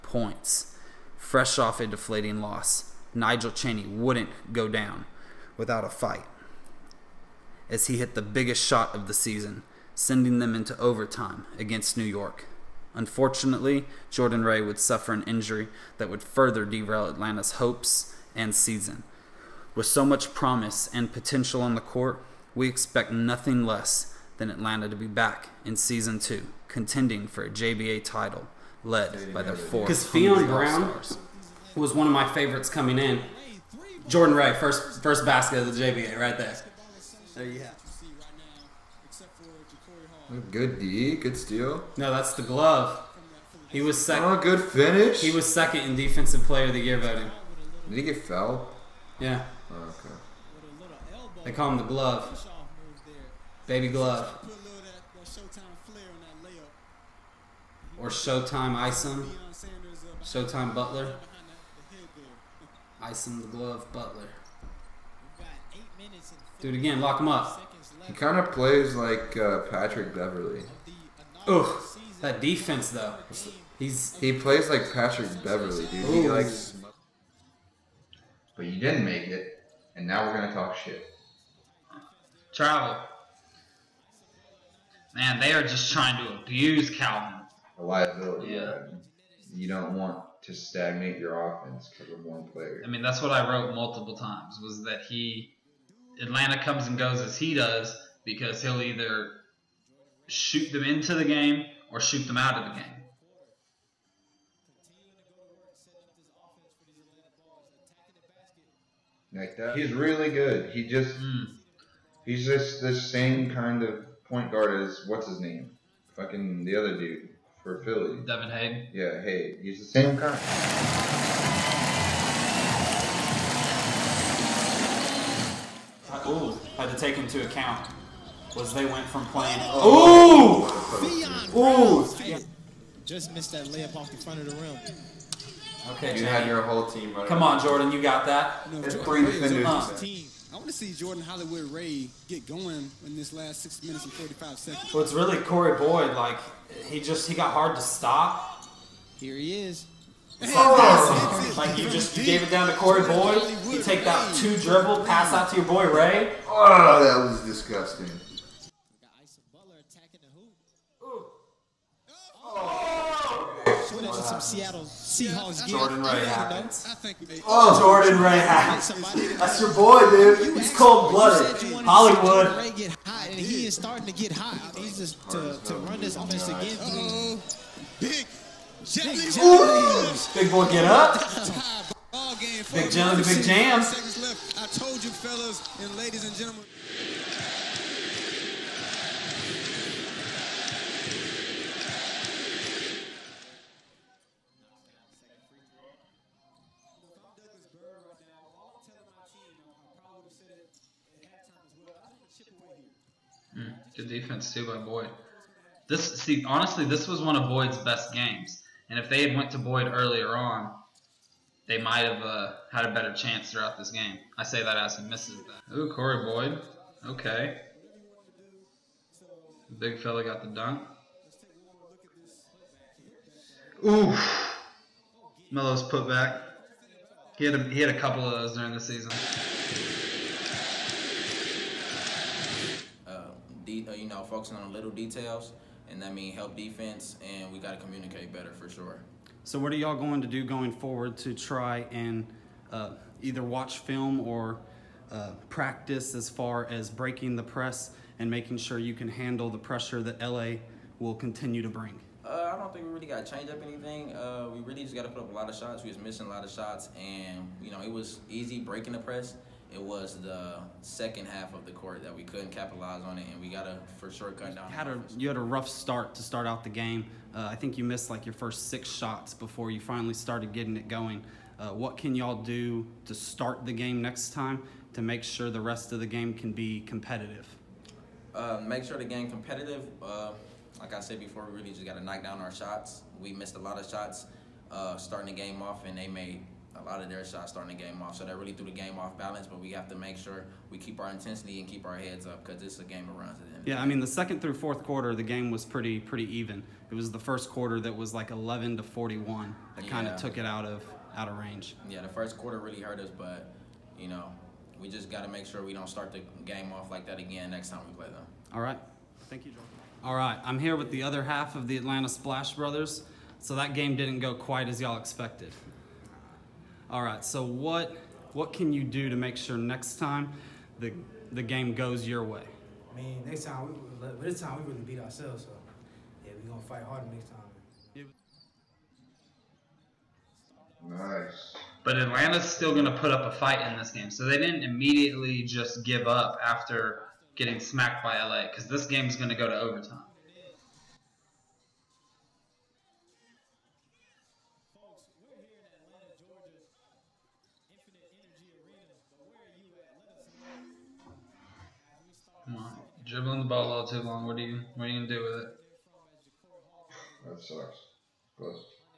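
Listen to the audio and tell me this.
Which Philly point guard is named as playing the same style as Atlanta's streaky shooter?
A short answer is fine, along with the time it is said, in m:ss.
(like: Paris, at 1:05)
Devin Hay, at 1:58.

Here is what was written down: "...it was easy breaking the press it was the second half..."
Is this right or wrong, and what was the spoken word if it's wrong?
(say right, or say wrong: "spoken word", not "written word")
right.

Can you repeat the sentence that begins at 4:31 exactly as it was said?
Uh, what can y'all do to start the game next time to make sure the rest of the game can be competitive?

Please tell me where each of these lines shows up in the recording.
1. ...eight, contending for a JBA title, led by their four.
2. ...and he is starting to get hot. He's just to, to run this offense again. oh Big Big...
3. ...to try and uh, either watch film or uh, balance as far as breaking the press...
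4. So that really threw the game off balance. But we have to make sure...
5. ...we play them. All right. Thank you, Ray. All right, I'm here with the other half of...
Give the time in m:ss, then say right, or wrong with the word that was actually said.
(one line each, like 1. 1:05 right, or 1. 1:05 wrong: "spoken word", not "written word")
1. 0:26 wrong: "two", not "eight"
2. 2:53 right
3. 4:01 wrong: "practice", not "balance"
4. 4:48 right
5. 5:07 wrong: "Jordan", not "Ray".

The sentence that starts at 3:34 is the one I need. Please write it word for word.
I say that as he misses that.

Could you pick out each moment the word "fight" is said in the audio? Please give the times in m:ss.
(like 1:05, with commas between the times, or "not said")
0:05, 5:26, 5:33.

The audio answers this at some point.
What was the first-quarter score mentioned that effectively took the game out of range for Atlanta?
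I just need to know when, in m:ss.
4:58.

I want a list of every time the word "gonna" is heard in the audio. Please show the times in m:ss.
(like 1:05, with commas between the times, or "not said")
1:20, 5:26, 5:55.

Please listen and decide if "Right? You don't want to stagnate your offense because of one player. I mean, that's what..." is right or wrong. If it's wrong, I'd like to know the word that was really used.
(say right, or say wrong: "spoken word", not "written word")
right.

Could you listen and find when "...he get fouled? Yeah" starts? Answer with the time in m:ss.
0:47.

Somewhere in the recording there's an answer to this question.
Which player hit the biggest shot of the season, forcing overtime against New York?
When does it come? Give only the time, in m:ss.
0:03.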